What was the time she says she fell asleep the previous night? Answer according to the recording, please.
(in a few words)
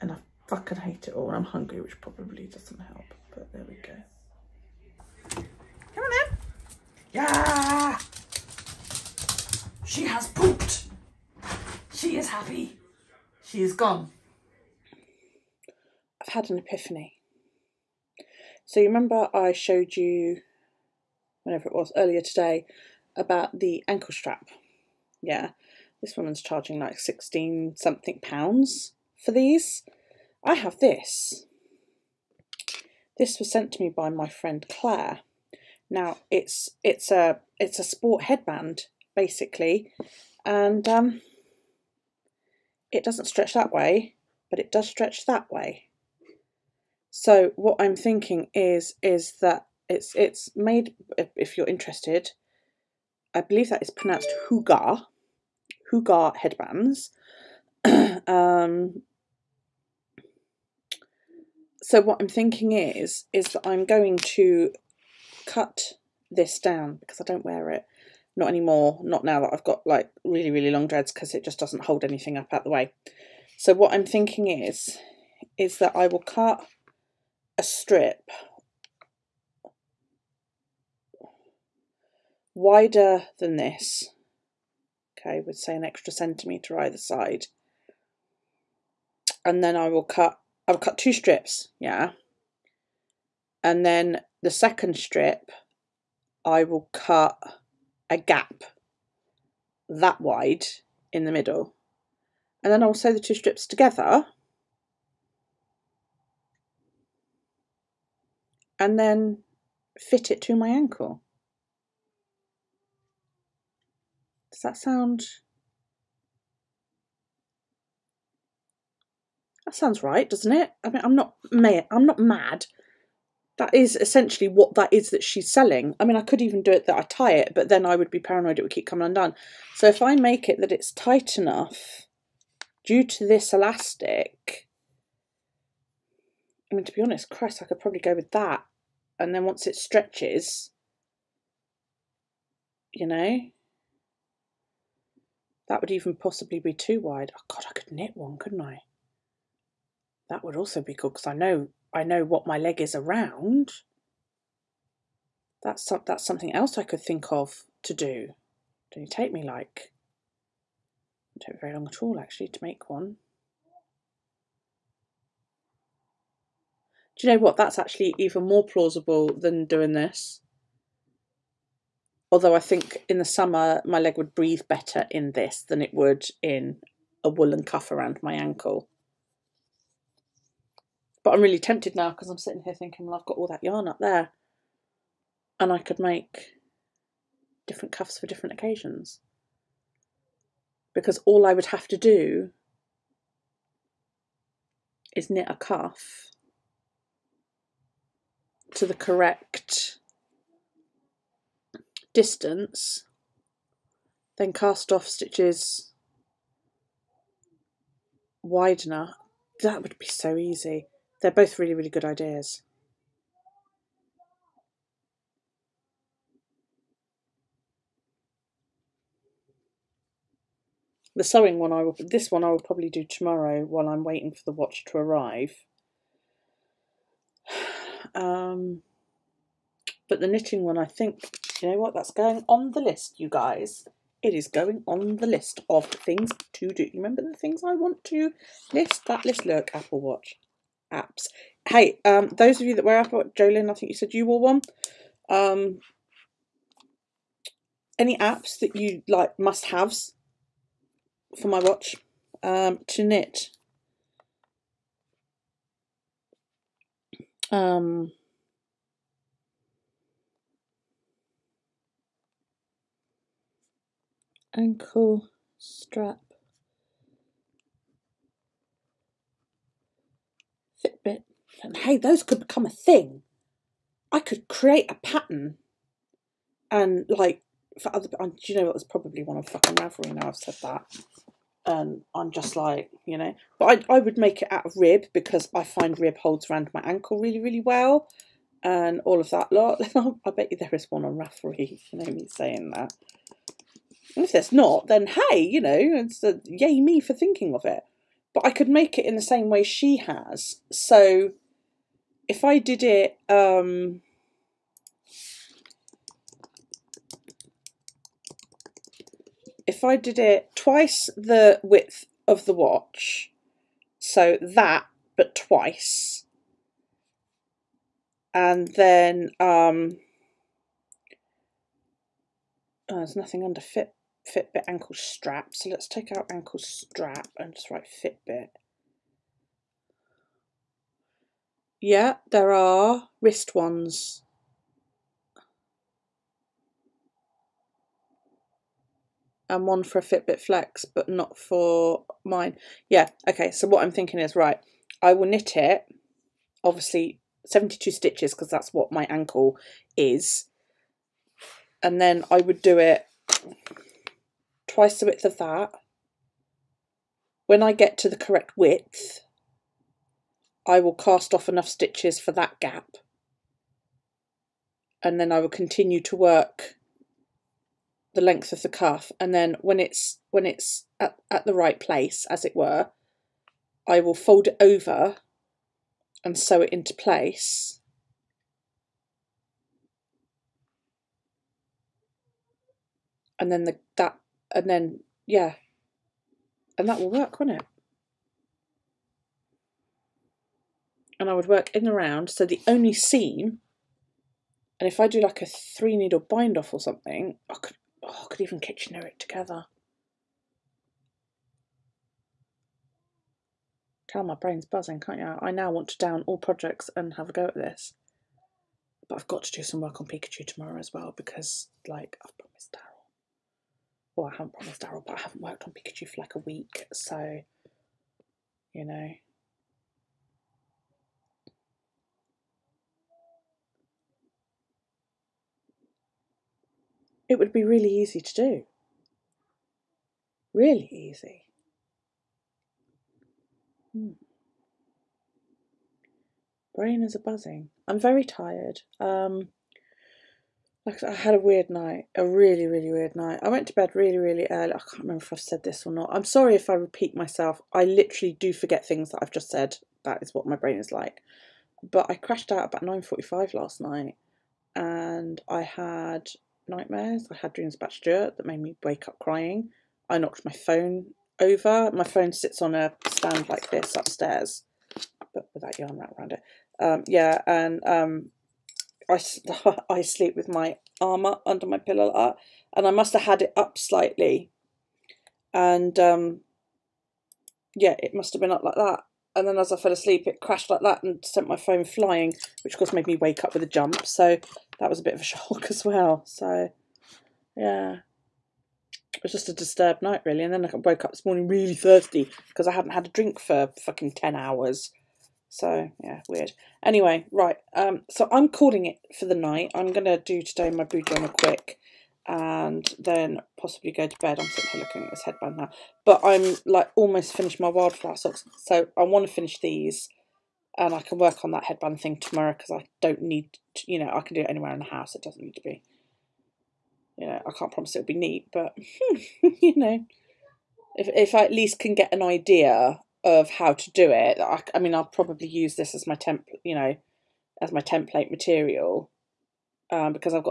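9:45.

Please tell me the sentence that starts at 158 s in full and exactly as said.
Do not take me like, it took very long at all actually to make one.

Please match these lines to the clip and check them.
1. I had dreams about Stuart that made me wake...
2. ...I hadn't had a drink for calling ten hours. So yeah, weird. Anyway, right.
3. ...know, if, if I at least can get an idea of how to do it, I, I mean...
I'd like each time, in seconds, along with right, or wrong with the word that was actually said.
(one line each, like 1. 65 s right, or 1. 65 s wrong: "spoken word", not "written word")
1. 457 s right
2. 492 s wrong: "fucking", not "calling"
3. 519 s right.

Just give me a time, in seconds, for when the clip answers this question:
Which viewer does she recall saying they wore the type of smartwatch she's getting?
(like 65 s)
243 s.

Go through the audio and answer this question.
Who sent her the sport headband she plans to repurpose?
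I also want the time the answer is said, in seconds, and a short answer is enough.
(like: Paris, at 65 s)
Claire, at 34 s.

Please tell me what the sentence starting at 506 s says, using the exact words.
But I'm like almost finished my wildflower socks.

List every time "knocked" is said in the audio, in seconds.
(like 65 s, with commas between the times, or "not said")
460 s.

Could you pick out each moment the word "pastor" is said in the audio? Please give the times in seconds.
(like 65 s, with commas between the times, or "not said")
not said.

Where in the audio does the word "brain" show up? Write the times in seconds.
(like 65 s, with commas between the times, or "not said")
404 s, 436 s, 450 s.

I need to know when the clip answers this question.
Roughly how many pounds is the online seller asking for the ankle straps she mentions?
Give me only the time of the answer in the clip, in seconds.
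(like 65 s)
27 s.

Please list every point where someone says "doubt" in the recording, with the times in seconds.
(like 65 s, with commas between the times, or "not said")
not said.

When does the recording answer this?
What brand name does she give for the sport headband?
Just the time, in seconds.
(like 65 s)
55 s.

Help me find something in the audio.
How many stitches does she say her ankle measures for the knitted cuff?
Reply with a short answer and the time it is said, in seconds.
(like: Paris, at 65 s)
72, at 347 s.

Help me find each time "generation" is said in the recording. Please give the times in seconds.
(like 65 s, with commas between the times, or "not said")
not said.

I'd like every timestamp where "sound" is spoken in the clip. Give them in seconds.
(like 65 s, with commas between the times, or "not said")
114 s, 119 s.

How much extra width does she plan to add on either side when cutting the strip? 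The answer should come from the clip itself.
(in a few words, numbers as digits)
1 centimetre.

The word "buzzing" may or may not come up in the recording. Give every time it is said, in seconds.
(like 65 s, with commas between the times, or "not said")
404 s, 437 s.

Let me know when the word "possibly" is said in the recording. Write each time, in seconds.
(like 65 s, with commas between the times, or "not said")
146 s, 503 s.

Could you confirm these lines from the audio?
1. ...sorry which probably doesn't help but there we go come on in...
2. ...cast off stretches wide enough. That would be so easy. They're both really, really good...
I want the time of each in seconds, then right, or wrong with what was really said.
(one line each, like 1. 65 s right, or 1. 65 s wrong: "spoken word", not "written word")
1. 1 s wrong: "hungry", not "sorry"
2. 204 s wrong: "stitches", not "stretches".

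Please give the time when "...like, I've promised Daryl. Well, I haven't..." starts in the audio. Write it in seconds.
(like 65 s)
411 s.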